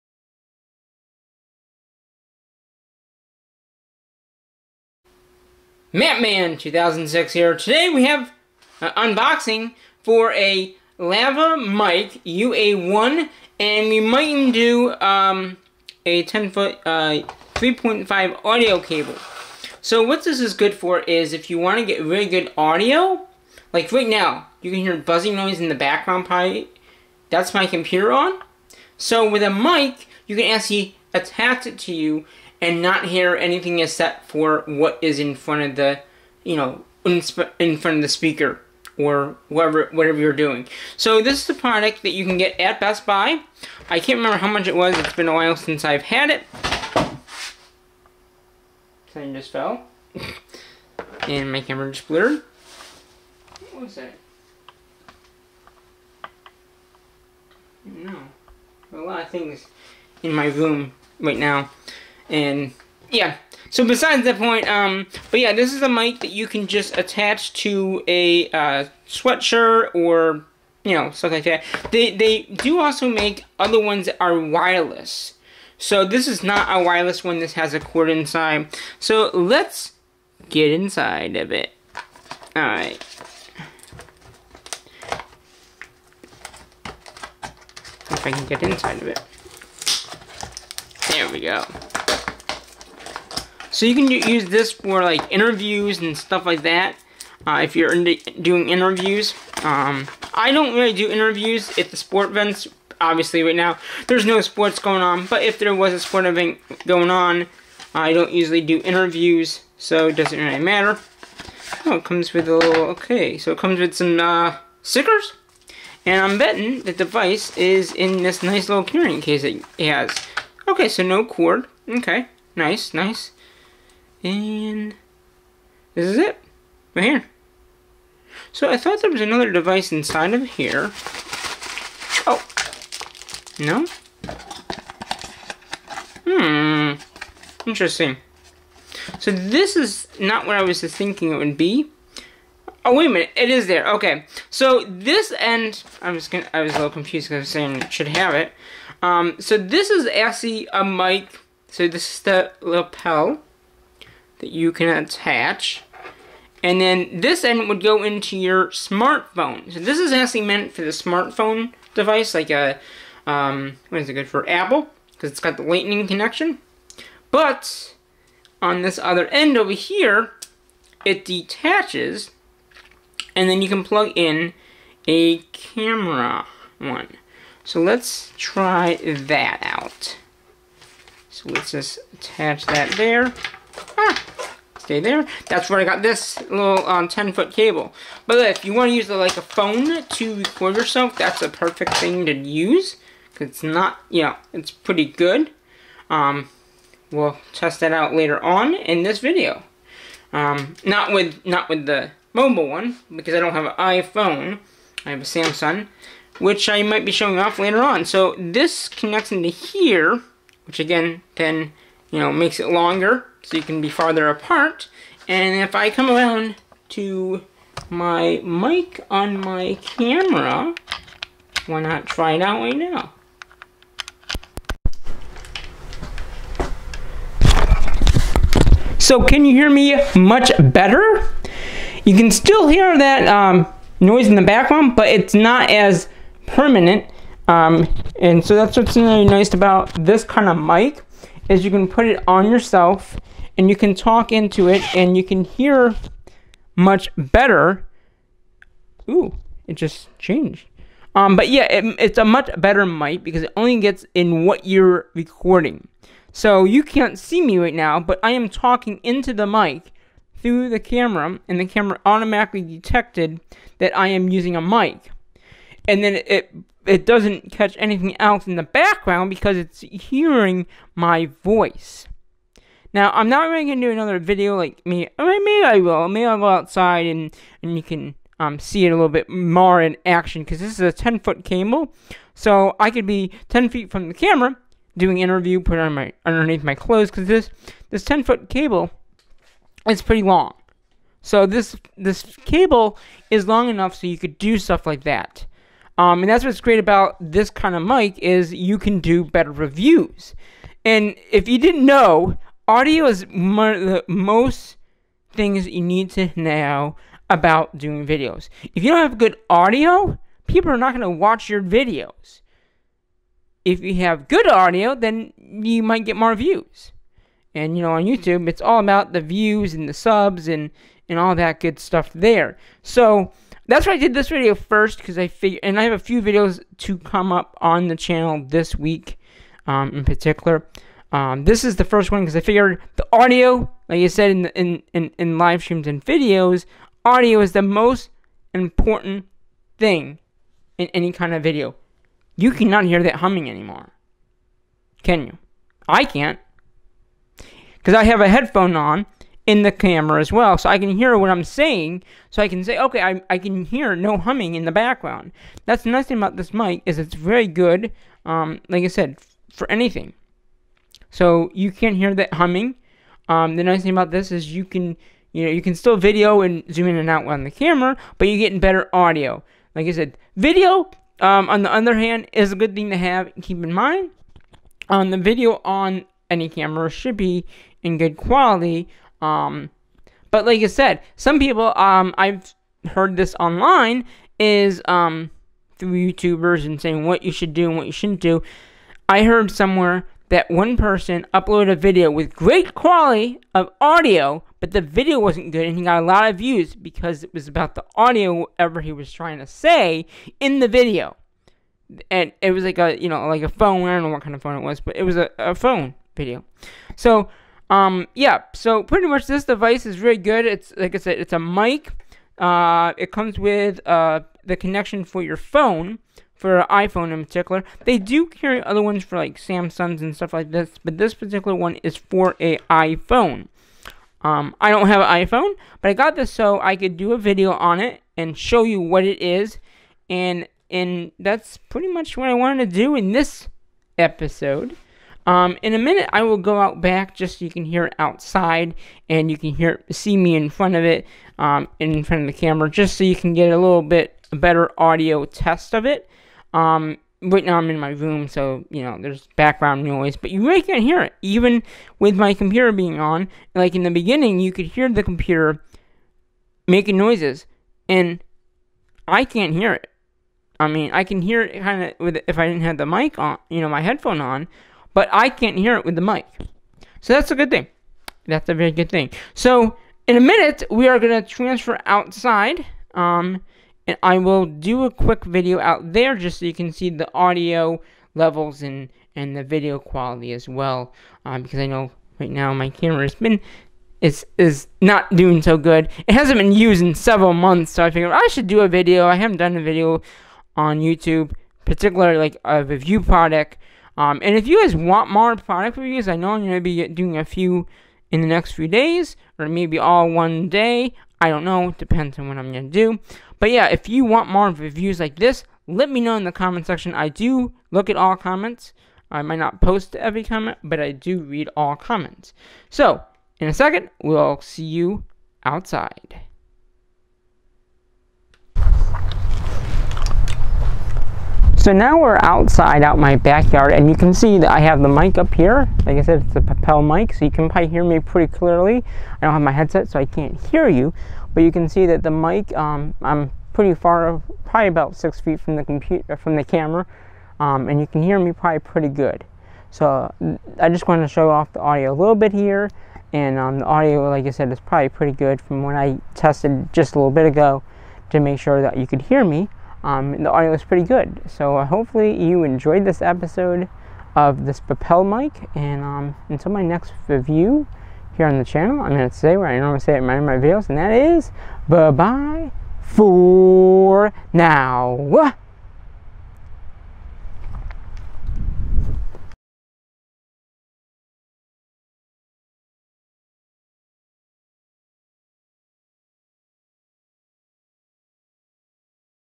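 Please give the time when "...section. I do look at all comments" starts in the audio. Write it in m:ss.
8:26.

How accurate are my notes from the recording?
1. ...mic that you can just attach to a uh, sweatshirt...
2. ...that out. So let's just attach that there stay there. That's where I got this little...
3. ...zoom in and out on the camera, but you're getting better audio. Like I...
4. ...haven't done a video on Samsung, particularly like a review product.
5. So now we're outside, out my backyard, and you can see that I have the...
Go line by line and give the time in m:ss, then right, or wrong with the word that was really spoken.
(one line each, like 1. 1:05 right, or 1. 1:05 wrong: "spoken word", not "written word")
1. 1:05 right
2. 2:59 right
3. 6:06 right
4. 8:09 wrong: "YouTube", not "Samsung"
5. 8:41 right.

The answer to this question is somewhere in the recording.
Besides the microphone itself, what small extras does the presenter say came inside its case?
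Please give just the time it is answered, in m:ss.
1:54.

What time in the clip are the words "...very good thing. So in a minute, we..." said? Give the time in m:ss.
7:48.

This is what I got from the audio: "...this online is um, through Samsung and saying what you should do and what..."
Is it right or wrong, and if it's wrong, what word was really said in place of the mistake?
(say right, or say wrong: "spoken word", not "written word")
wrong: "YouTubers", not "Samsung".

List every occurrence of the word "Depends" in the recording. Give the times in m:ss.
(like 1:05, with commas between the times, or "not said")
8:21.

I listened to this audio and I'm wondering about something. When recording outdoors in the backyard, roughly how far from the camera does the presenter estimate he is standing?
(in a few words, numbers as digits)
6 feet.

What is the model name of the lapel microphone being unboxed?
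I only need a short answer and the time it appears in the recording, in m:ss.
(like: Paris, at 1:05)
LavMicro UA1, at 0:10.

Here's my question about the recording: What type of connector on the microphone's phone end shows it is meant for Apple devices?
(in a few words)
lightning connection.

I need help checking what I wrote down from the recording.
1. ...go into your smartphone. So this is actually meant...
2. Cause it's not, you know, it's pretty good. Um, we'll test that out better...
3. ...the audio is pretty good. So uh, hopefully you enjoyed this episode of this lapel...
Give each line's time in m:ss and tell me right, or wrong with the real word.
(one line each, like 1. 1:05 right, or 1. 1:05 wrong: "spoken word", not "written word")
1. 2:37 right
2. 3:13 wrong: "later", not "better"
3. 9:10 right.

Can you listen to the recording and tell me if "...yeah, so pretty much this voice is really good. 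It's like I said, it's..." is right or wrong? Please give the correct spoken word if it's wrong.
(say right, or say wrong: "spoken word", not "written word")
wrong: "device", not "voice".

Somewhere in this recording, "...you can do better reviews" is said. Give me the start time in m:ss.
4:58.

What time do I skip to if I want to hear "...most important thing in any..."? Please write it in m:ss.
5:37.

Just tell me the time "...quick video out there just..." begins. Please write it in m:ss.
7:54.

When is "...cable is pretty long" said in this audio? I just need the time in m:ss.
4:48.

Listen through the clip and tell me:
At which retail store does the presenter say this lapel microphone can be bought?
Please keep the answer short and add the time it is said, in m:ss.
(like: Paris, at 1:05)
Best Buy, at 0:42.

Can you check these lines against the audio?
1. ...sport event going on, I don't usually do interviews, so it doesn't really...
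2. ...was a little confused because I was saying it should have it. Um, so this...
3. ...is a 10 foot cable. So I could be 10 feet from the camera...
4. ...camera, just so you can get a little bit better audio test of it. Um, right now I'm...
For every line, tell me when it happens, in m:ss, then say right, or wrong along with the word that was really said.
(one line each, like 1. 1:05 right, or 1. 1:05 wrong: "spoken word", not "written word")
1. 1:45 right
2. 2:26 right
3. 4:40 right
4. 7:22 right.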